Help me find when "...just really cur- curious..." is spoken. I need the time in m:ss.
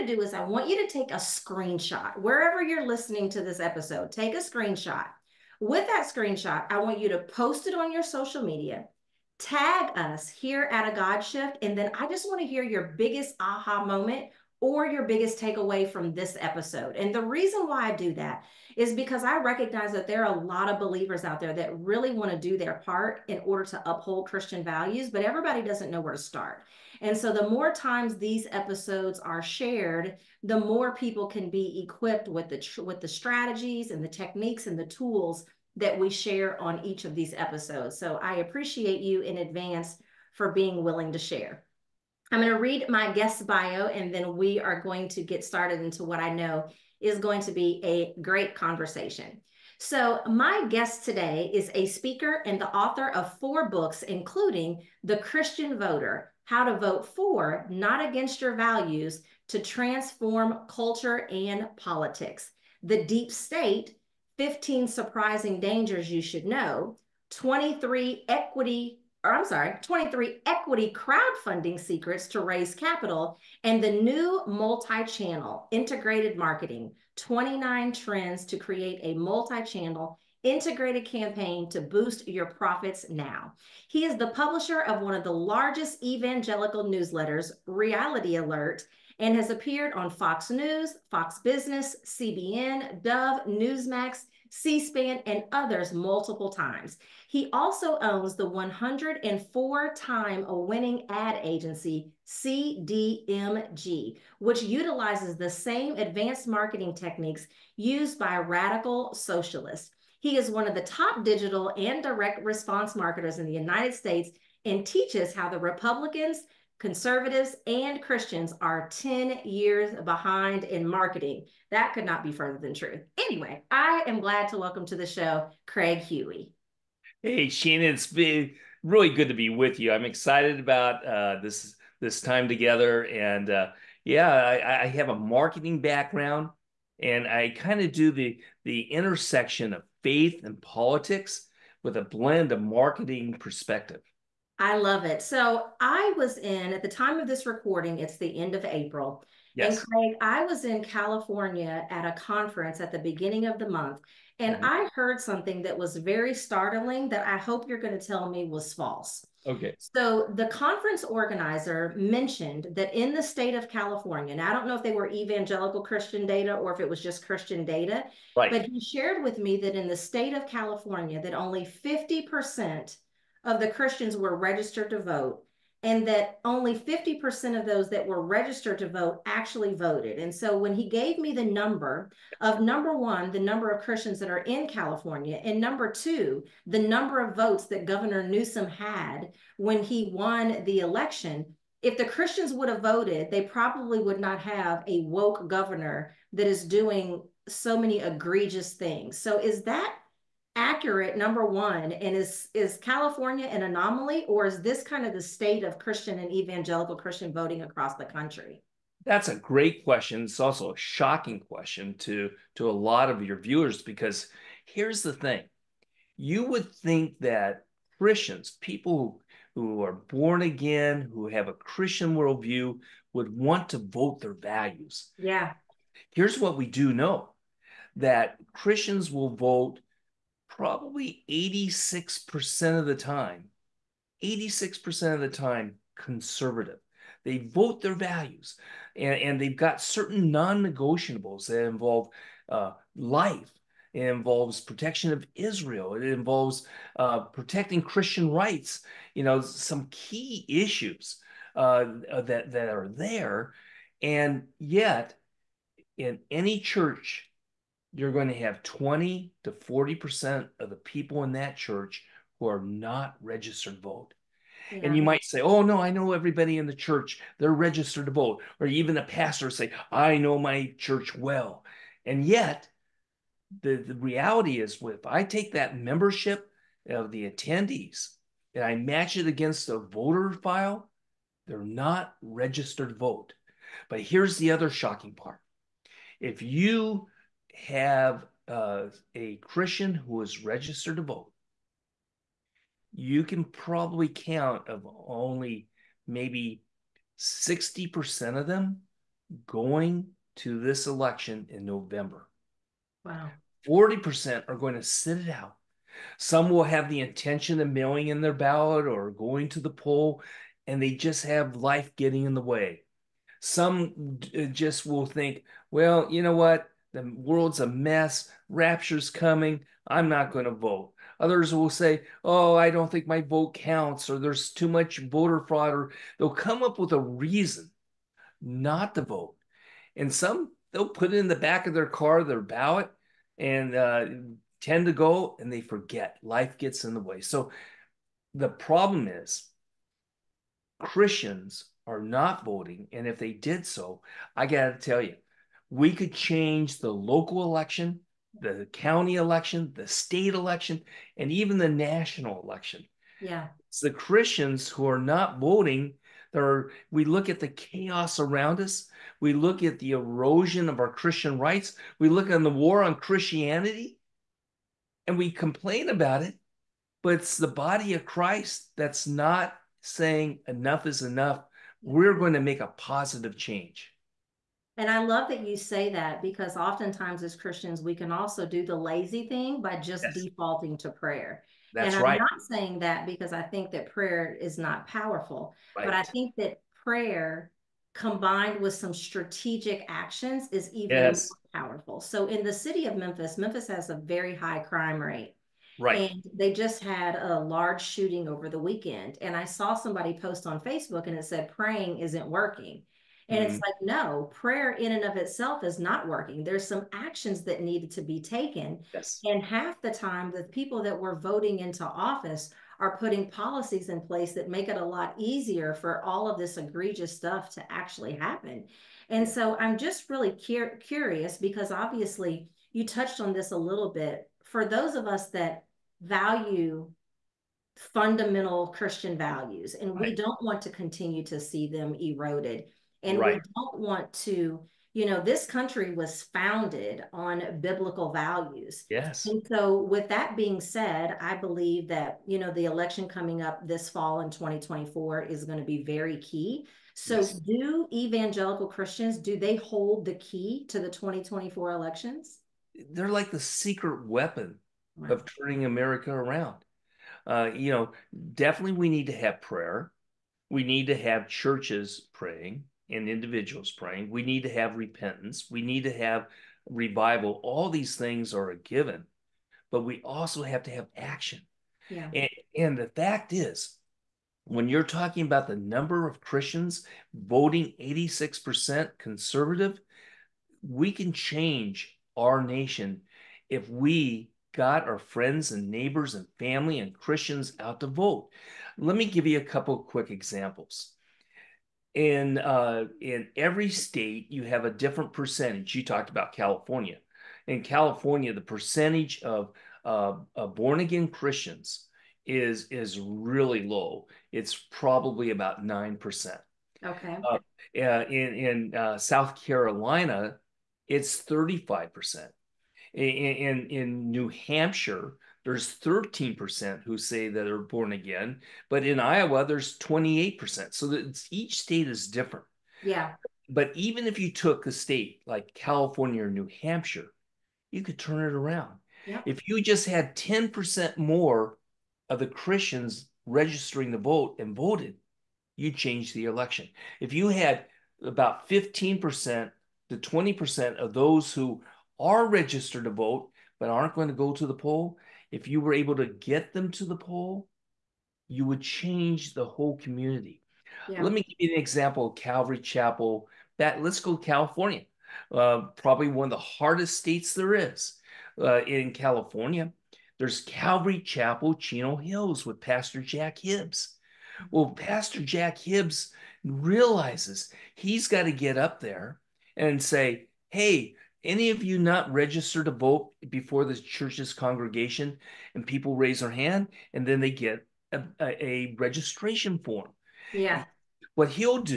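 6:59.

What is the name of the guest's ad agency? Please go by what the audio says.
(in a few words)
CDMG.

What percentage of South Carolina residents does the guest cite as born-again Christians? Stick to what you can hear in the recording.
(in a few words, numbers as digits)
35%.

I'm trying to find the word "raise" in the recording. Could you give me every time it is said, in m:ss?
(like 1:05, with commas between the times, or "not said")
1:12, 9:35.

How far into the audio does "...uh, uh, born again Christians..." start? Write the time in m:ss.
8:19.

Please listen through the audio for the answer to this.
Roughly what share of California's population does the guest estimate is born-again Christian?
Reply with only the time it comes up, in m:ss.
8:25.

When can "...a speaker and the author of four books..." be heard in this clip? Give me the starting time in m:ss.
0:51.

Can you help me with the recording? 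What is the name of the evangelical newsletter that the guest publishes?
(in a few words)
Reality Alert.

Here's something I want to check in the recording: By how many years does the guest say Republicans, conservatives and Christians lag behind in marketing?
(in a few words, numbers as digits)
10 years.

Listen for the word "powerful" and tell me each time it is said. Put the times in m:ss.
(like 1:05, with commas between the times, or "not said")
6:24, 6:31.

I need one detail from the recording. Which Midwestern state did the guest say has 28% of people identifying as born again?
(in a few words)
Iowa.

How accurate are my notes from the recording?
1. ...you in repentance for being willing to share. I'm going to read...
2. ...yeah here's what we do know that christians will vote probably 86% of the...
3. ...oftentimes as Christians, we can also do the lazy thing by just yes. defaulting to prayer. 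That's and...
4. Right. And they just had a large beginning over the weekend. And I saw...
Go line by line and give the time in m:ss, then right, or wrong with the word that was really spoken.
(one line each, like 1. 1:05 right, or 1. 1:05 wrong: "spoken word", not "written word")
1. 0:38 wrong: "advance", not "repentance"
2. 3:45 right
3. 6:16 right
4. 6:35 wrong: "shooting", not "beginning".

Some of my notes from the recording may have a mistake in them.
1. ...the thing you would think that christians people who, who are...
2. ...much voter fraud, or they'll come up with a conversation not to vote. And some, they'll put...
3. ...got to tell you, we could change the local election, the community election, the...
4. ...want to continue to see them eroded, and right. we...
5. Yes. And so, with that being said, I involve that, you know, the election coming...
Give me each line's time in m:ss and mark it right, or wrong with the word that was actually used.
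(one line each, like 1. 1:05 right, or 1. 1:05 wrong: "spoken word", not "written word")
1. 3:35 right
2. 5:24 wrong: "reason", not "conversation"
3. 5:44 wrong: "county", not "community"
4. 7:10 right
5. 7:18 wrong: "believe", not "involve".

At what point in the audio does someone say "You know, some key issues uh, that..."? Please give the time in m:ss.
4:09.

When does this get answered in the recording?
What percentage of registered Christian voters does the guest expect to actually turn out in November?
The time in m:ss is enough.
4:57.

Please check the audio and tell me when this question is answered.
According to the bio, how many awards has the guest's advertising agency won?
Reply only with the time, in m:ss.
1:38.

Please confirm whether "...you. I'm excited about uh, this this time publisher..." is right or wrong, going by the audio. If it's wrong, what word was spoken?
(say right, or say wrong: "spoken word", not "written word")
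wrong: "together", not "publisher".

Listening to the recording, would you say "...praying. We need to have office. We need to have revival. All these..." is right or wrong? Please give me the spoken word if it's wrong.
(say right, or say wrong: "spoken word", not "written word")
wrong: "repentance", not "office".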